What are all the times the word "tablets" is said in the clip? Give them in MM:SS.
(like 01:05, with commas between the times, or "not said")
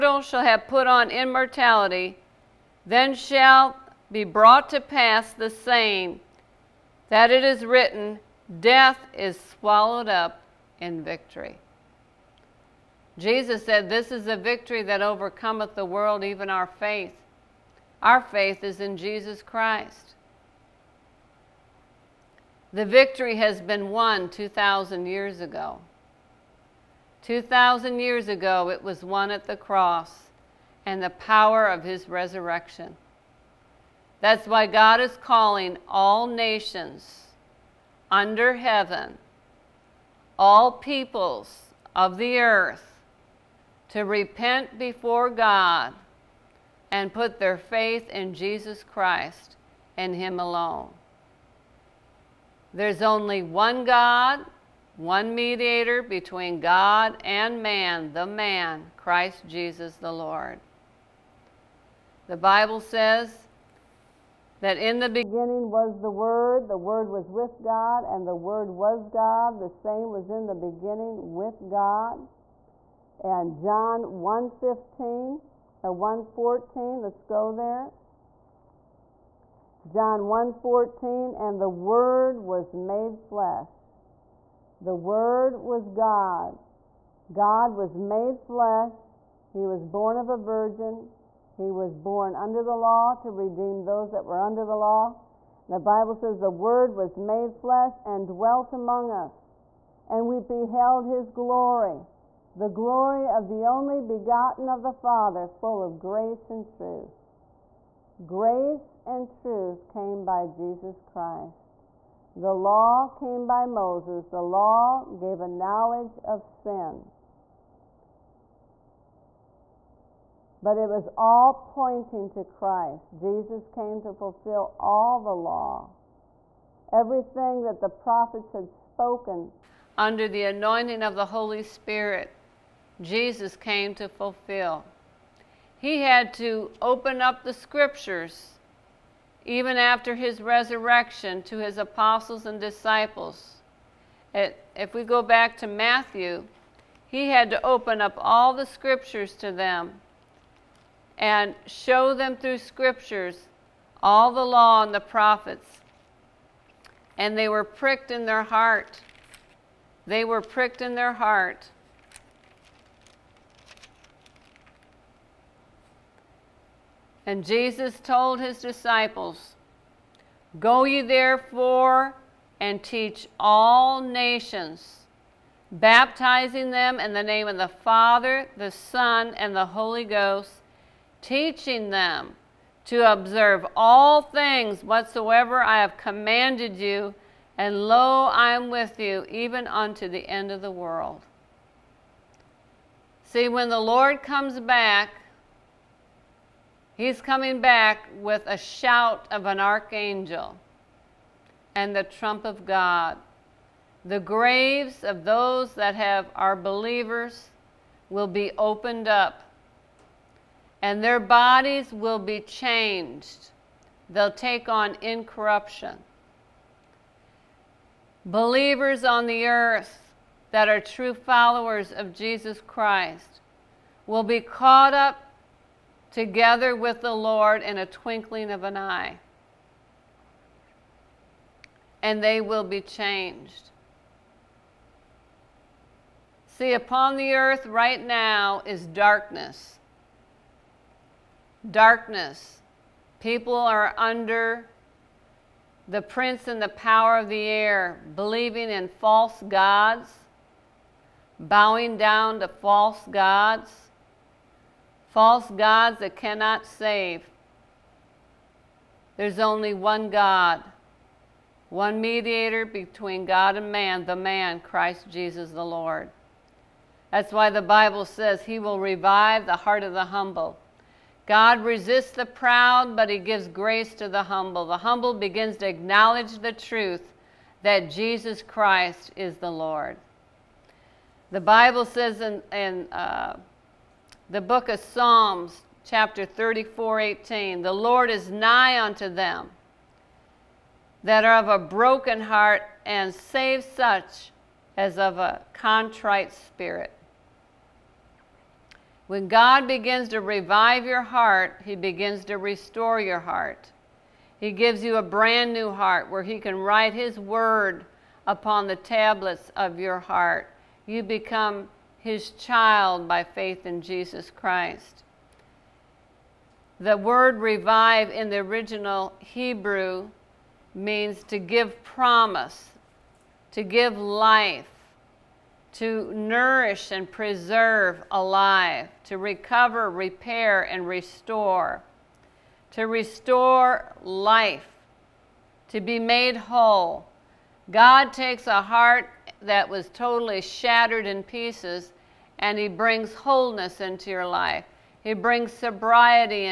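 05:08.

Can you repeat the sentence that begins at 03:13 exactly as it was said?
See, when the Lord comes back, He's coming back with a shout of an archangel and the trump of God.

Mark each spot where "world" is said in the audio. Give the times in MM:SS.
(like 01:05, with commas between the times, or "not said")
00:15, 03:10.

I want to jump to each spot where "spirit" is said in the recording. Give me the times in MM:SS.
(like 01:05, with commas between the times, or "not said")
02:11, 04:56.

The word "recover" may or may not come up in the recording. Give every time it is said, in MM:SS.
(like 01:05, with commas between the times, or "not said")
05:29.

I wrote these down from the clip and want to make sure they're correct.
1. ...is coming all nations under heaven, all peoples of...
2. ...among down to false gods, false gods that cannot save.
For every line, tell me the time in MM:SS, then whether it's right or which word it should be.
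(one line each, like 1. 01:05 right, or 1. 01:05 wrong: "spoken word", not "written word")
1. 00:34 wrong: "calling", not "coming"
2. 04:11 wrong: "bowing", not "among".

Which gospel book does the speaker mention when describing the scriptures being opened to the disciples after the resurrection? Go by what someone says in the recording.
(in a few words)
Matthew.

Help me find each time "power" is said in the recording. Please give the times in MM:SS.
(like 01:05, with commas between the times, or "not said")
00:31, 04:06.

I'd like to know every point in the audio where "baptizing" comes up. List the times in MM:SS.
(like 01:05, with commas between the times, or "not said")
02:55.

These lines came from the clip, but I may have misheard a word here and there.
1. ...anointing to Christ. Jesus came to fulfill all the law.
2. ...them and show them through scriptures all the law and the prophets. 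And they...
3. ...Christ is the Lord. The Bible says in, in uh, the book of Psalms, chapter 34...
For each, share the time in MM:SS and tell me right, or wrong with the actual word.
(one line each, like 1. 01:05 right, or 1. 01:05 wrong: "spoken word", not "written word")
1. 02:01 wrong: "pointing", not "anointing"
2. 02:29 right
3. 04:38 right.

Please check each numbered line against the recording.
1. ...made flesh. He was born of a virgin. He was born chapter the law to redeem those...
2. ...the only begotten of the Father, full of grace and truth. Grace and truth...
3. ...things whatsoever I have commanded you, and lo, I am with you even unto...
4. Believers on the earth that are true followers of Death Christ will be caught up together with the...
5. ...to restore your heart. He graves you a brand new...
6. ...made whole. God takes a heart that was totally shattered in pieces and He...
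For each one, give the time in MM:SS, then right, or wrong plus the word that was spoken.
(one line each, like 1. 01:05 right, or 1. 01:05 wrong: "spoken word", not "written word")
1. 01:27 wrong: "under", not "chapter"
2. 01:43 right
3. 03:04 right
4. 03:38 wrong: "Jesus", not "Death"
5. 05:02 wrong: "gives", not "graves"
6. 05:35 right.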